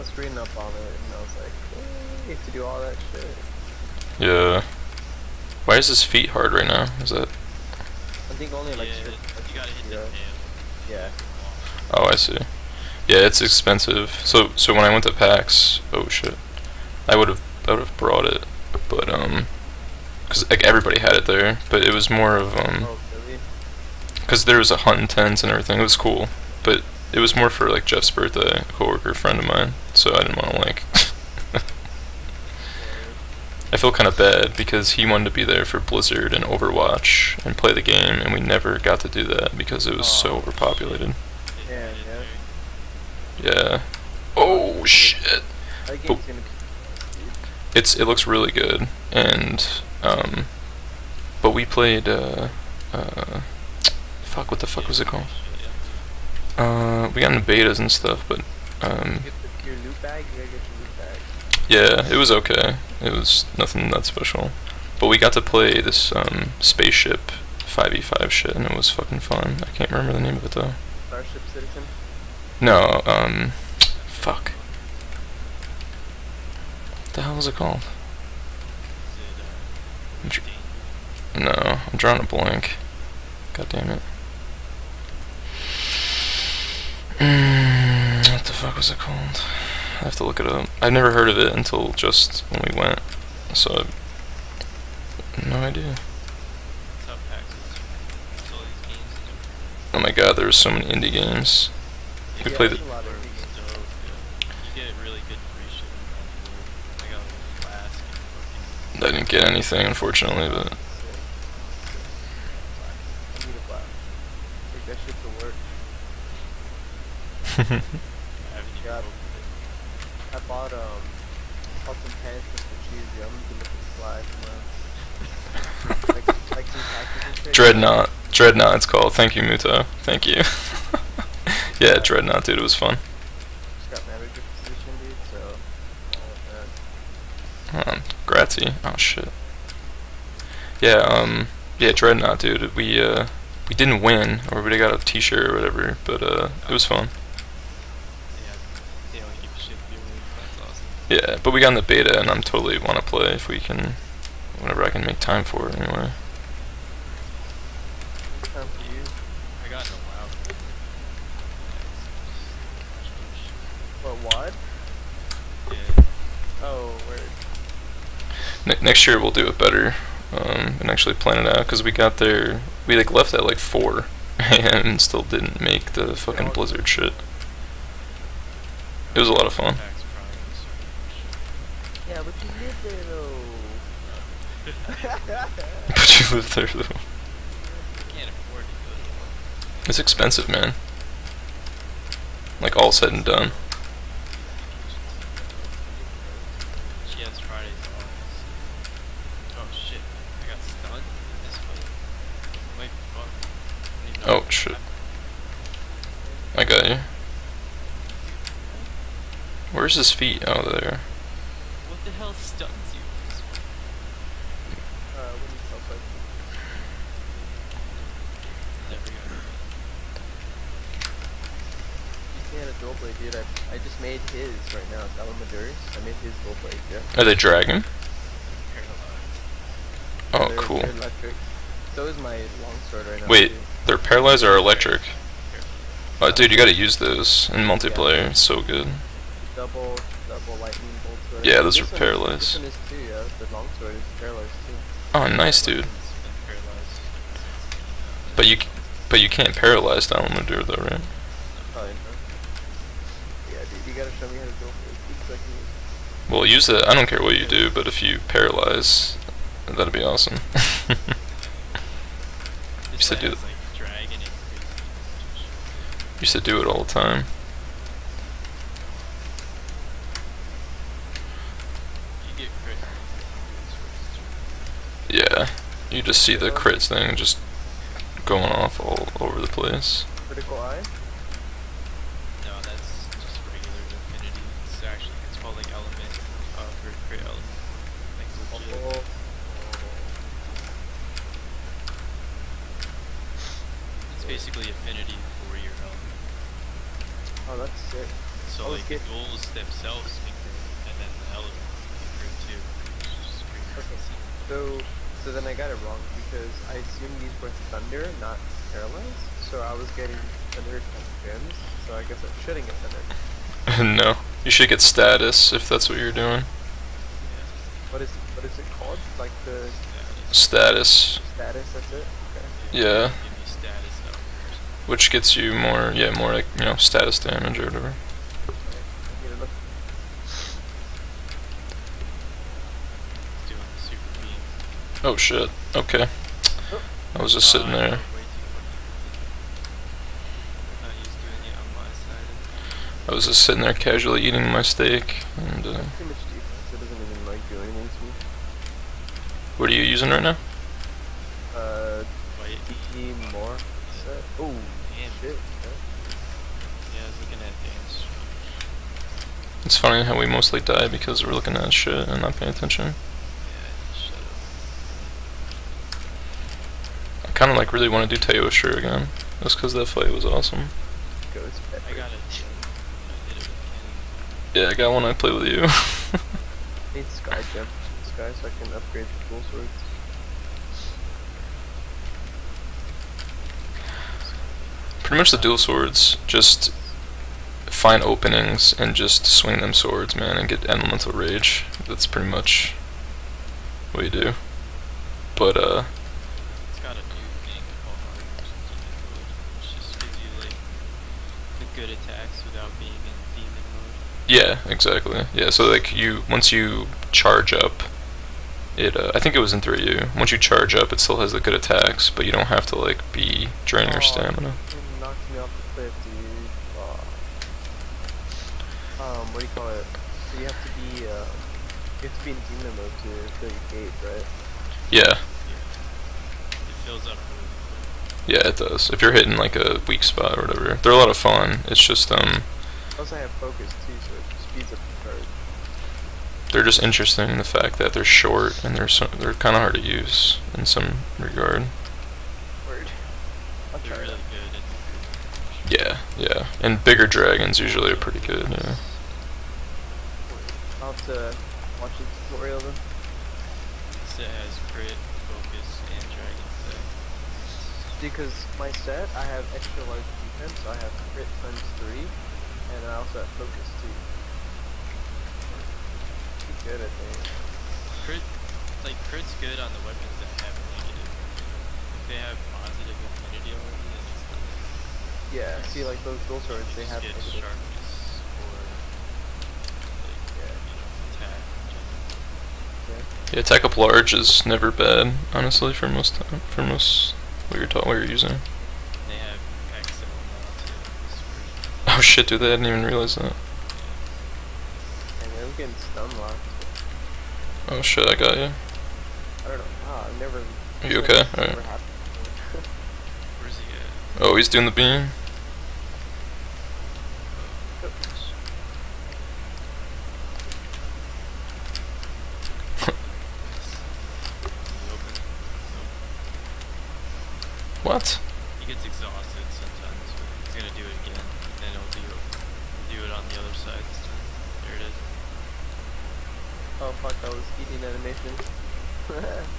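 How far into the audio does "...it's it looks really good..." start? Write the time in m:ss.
0:47.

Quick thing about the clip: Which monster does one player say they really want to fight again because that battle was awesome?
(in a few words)
Teostra.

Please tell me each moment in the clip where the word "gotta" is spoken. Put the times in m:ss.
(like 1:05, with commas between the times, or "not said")
0:09, 3:56, 4:13.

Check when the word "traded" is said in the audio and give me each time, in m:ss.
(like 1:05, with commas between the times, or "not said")
not said.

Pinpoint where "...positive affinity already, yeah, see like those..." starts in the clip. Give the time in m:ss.
7:52.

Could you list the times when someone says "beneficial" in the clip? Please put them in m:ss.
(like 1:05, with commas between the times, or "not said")
not said.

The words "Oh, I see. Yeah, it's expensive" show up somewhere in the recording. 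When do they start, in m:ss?
0:11.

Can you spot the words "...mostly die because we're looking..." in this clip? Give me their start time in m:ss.
6:00.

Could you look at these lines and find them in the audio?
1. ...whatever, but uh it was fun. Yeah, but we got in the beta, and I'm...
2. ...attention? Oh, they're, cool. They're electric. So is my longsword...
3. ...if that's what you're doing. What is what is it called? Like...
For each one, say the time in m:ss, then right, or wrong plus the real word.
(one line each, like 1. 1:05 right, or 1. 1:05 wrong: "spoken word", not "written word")
1. 2:25 right
2. 3:47 wrong: "dragon", not "attention"
3. 5:15 right.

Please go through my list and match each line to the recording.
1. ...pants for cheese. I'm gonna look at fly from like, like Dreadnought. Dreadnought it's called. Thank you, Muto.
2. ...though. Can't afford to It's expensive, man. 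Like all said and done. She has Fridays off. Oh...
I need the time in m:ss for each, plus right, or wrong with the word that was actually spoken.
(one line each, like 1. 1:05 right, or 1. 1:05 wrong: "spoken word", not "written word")
1. 2:02 right
2. 3:06 right.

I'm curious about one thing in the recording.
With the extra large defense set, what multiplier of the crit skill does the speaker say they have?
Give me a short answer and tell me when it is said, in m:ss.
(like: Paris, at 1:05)
3, at 7:41.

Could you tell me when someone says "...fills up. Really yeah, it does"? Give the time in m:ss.
7:06.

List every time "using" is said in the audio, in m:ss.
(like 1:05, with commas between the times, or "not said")
5:49, 8:08.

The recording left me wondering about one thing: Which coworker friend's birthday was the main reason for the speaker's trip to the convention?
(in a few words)
Jeff.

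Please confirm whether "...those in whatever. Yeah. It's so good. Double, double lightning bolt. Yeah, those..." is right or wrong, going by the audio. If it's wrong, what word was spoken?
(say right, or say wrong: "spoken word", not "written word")
wrong: "multiplayer", not "whatever".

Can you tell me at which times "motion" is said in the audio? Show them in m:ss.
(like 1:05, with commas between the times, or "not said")
not said.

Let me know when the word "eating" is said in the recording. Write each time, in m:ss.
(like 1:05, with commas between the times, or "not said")
5:44, 8:47.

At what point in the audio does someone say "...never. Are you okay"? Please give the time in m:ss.
8:20.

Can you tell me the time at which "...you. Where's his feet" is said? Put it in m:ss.
3:26.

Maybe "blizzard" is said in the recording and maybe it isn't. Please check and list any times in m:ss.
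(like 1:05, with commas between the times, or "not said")
0:35, 2:56.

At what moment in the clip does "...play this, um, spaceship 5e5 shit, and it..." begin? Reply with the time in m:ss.
1:05.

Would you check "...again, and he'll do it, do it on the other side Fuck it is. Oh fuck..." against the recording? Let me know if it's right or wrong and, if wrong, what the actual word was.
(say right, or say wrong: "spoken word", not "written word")
wrong: "There", not "Fuck".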